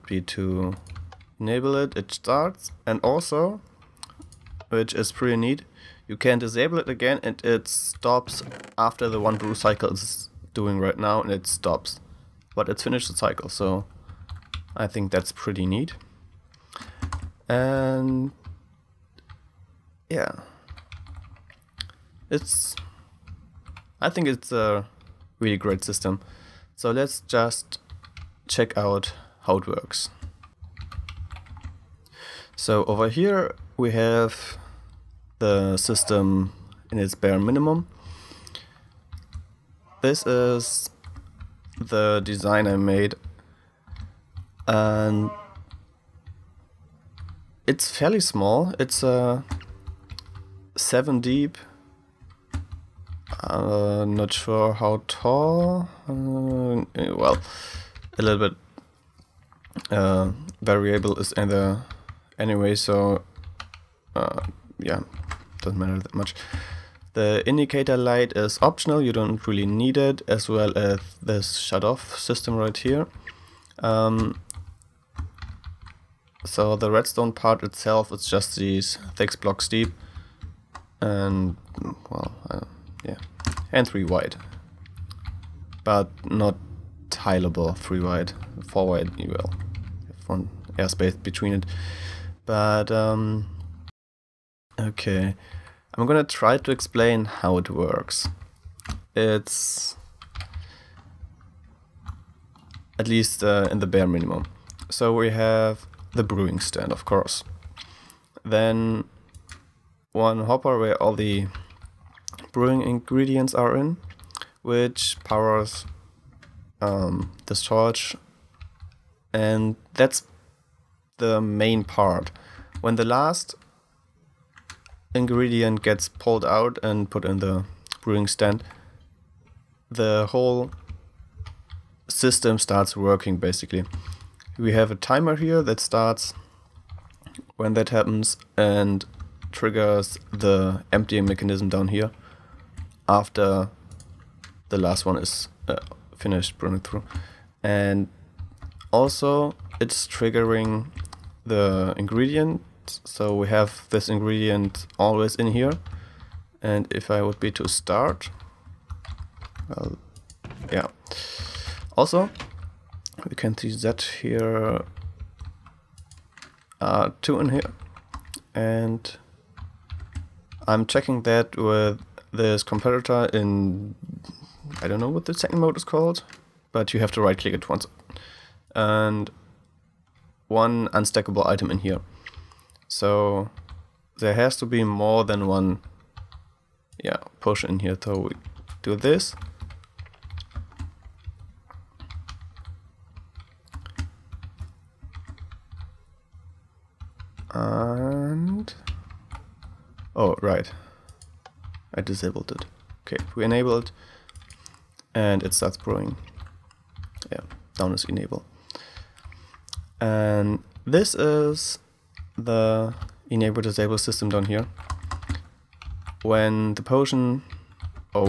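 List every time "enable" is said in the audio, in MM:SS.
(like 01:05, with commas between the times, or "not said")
00:01, 03:23, 03:28, 03:33.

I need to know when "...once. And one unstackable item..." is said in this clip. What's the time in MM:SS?
02:57.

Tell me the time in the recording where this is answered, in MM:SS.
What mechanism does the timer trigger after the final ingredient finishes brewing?
02:20.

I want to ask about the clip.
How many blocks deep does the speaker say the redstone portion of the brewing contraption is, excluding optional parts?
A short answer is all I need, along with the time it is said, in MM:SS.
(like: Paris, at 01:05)
6, at 01:19.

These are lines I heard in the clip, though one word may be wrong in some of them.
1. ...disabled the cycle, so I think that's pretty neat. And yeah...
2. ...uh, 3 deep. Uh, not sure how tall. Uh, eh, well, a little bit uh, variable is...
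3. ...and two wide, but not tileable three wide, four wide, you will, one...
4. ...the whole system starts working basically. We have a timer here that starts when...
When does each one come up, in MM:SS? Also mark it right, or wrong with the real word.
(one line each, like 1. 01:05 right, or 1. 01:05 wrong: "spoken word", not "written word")
1. 00:12 wrong: "finished", not "disabled"
2. 00:49 wrong: "7", not "3"
3. 01:23 wrong: "three", not "two"
4. 02:09 right.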